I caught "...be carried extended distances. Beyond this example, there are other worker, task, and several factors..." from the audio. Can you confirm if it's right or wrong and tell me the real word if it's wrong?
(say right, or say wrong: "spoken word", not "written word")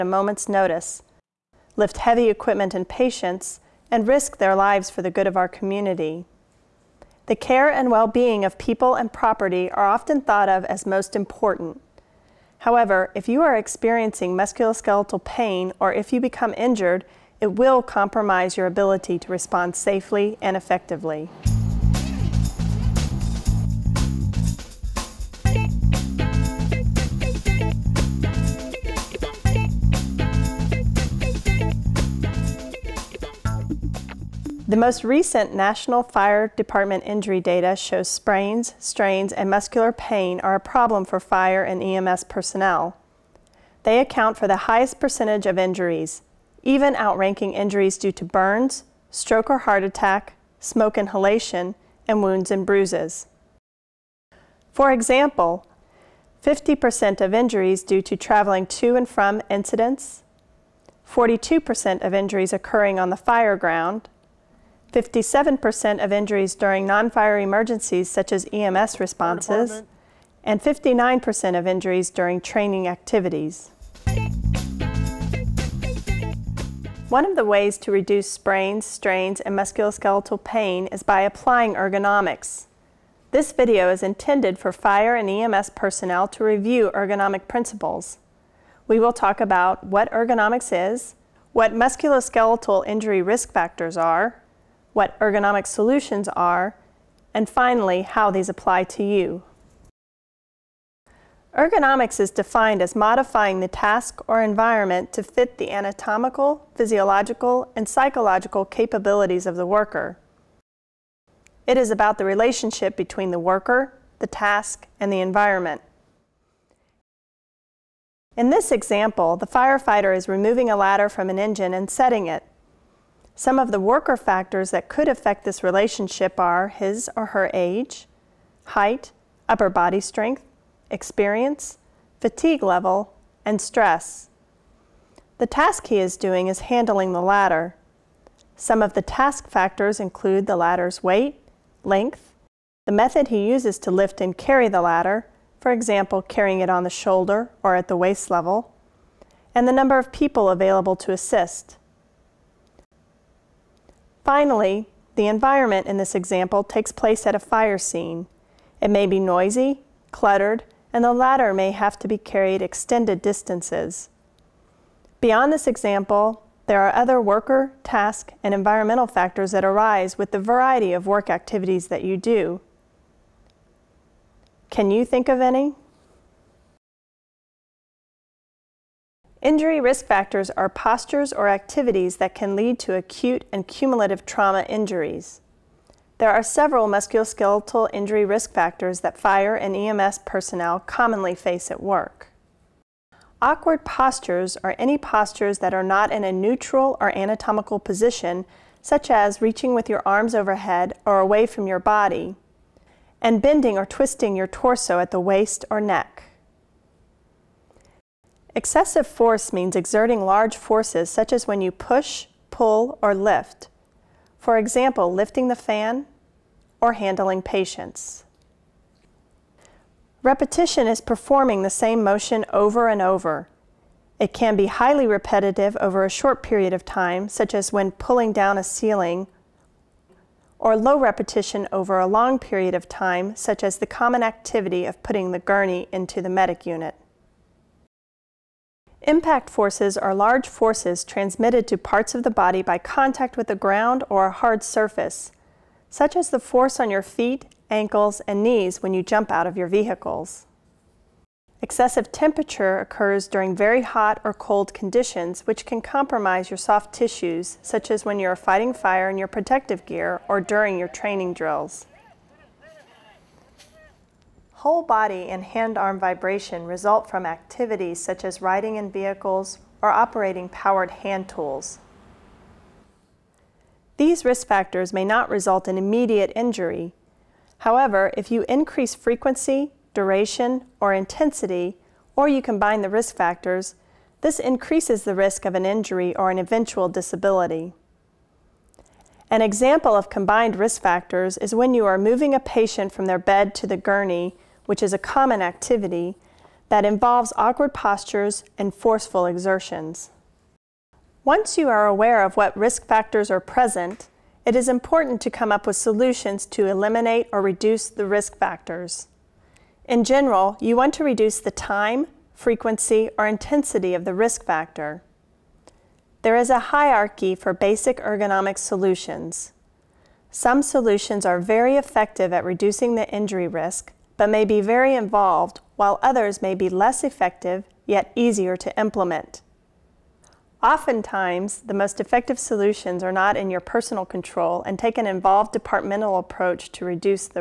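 wrong: "environmental", not "several".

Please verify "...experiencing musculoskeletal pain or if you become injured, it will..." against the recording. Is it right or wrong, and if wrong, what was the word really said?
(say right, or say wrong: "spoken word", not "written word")
right.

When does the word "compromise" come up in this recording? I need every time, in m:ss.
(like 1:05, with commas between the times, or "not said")
0:17, 4:15.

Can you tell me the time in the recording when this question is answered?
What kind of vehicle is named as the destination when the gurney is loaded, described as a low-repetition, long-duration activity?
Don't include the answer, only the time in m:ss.
3:56.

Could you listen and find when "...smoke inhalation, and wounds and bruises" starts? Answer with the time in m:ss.
0:50.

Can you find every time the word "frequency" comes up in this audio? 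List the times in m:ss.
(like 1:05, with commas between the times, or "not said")
4:38, 5:12.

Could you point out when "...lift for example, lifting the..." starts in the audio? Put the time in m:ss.
3:33.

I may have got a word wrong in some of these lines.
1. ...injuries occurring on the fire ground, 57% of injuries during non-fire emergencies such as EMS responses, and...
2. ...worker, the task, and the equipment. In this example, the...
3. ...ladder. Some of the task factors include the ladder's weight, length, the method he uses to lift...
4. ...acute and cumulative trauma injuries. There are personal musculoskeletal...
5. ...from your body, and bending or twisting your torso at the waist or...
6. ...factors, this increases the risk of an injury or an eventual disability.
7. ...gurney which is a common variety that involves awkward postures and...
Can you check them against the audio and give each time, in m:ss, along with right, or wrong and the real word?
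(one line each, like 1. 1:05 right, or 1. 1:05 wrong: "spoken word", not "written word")
1. 1:02 right
2. 1:53 wrong: "environment", not "equipment"
3. 2:17 right
4. 3:02 wrong: "several", not "personal"
5. 3:21 right
6. 4:43 right
7. 4:53 wrong: "activity", not "variety".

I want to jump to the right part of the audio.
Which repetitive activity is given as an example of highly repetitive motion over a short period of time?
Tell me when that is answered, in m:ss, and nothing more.
3:47.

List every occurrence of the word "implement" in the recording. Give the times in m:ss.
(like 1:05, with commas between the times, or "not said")
5:28.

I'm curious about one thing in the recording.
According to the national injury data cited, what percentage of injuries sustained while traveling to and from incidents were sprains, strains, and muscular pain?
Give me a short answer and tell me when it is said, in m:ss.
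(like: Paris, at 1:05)
50%, at 0:56.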